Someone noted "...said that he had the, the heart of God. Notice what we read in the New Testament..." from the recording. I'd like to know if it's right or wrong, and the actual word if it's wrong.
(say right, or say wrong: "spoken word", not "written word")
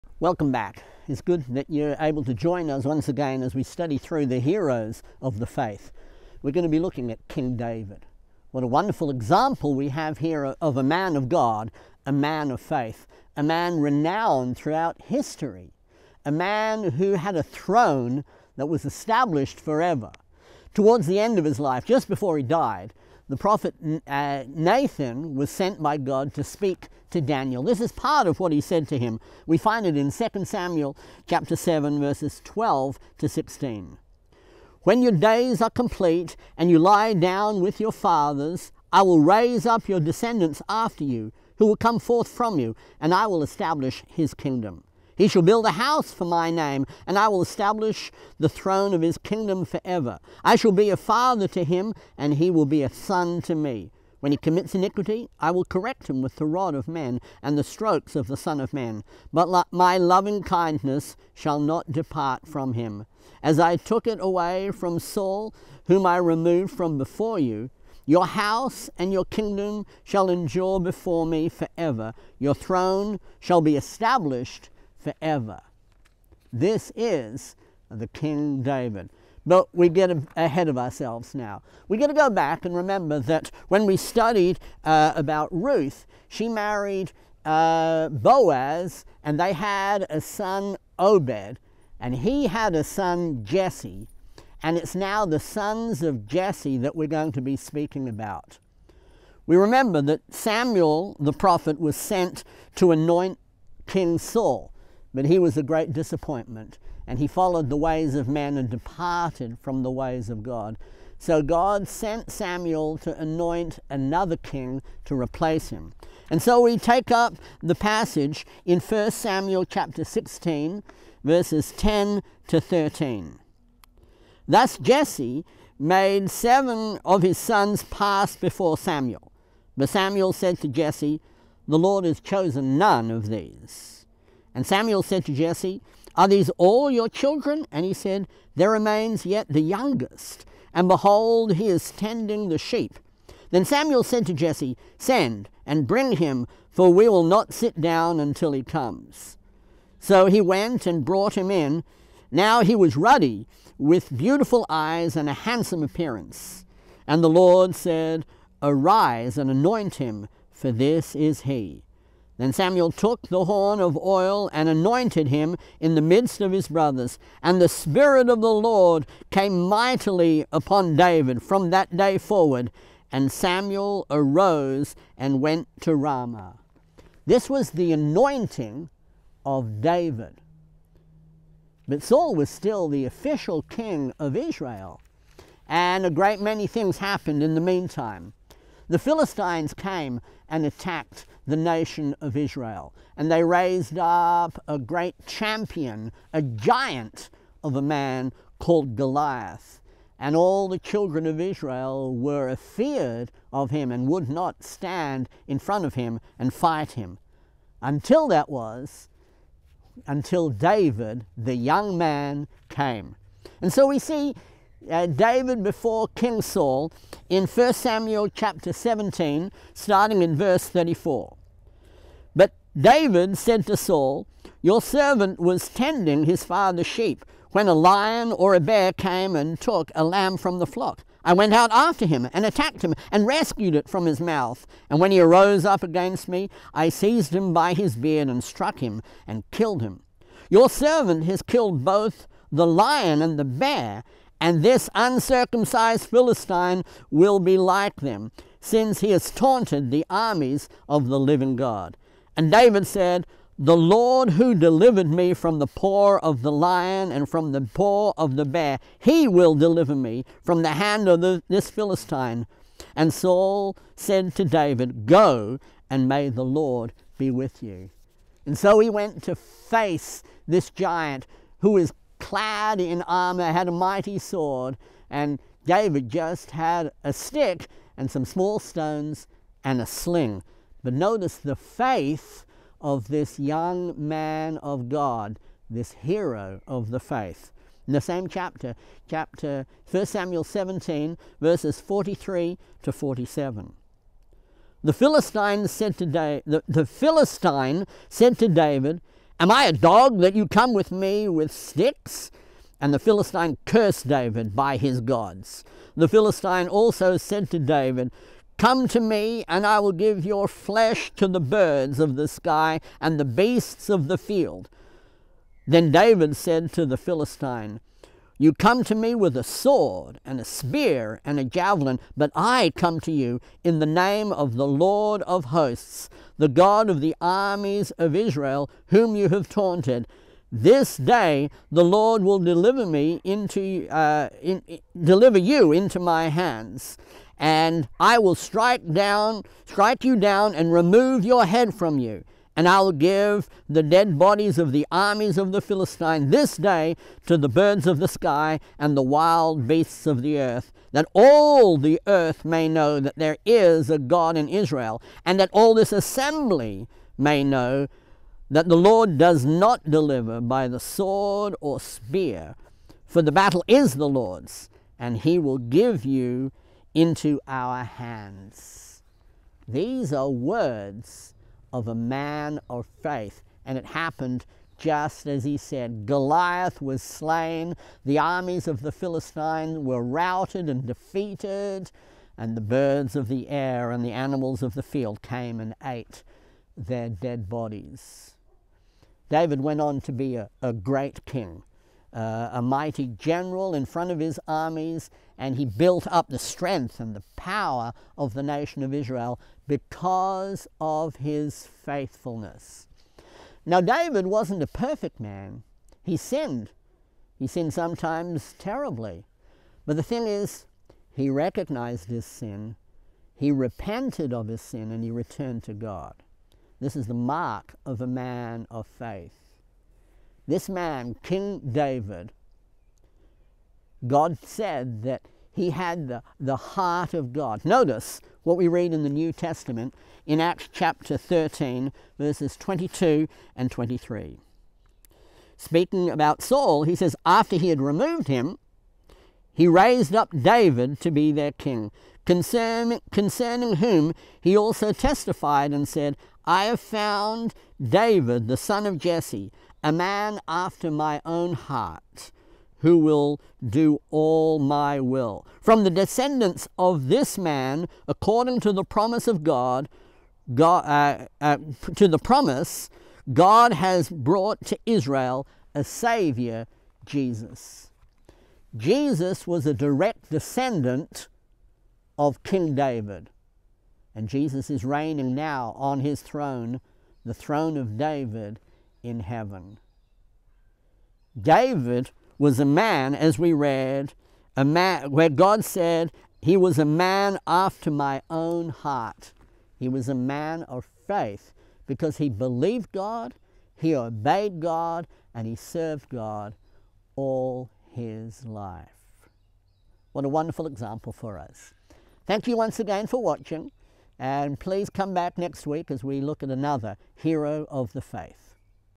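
right.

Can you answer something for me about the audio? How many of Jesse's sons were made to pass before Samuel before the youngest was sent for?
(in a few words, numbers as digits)
7.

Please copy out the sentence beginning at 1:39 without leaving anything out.
We remember that Samuel the prophet was sent to anoint King Saul.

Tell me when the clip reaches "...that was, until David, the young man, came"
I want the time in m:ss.
3:28.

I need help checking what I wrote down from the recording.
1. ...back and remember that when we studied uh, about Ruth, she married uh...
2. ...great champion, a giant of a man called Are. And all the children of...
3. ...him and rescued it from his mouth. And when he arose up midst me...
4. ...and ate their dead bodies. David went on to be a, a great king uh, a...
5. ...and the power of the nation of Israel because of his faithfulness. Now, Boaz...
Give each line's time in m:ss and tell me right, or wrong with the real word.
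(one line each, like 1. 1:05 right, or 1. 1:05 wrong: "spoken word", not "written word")
1. 1:22 right
2. 3:14 wrong: "Goliath", not "Are"
3. 3:52 wrong: "against", not "midst"
4. 6:25 right
5. 6:36 wrong: "David", not "Boaz".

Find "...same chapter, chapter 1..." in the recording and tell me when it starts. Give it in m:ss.
4:48.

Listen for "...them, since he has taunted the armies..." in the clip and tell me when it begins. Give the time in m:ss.
4:07.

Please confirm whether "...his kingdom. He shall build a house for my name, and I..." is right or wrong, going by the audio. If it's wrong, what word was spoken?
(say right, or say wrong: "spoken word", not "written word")
right.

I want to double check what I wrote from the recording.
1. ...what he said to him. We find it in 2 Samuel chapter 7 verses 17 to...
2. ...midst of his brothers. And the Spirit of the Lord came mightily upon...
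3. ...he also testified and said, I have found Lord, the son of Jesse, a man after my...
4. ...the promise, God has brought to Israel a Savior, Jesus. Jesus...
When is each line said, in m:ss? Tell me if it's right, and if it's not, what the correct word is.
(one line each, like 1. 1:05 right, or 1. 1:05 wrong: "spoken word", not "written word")
1. 0:28 wrong: "12", not "17"
2. 2:46 right
3. 7:24 wrong: "David", not "Lord"
4. 7:42 right.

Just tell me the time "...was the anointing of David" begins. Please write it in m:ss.
2:57.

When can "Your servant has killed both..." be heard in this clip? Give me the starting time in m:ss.
4:00.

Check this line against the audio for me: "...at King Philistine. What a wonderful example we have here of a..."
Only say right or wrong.
wrong.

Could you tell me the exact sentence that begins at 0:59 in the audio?
But my loving kindness shall not depart from him.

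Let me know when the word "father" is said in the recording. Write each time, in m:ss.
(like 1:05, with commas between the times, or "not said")
0:37, 0:50, 3:46.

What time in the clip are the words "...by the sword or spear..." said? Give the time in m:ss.
6:00.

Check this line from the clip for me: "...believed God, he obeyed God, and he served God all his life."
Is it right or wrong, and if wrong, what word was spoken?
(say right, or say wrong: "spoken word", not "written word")
right.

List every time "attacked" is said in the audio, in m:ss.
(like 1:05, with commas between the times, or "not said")
3:10, 3:52.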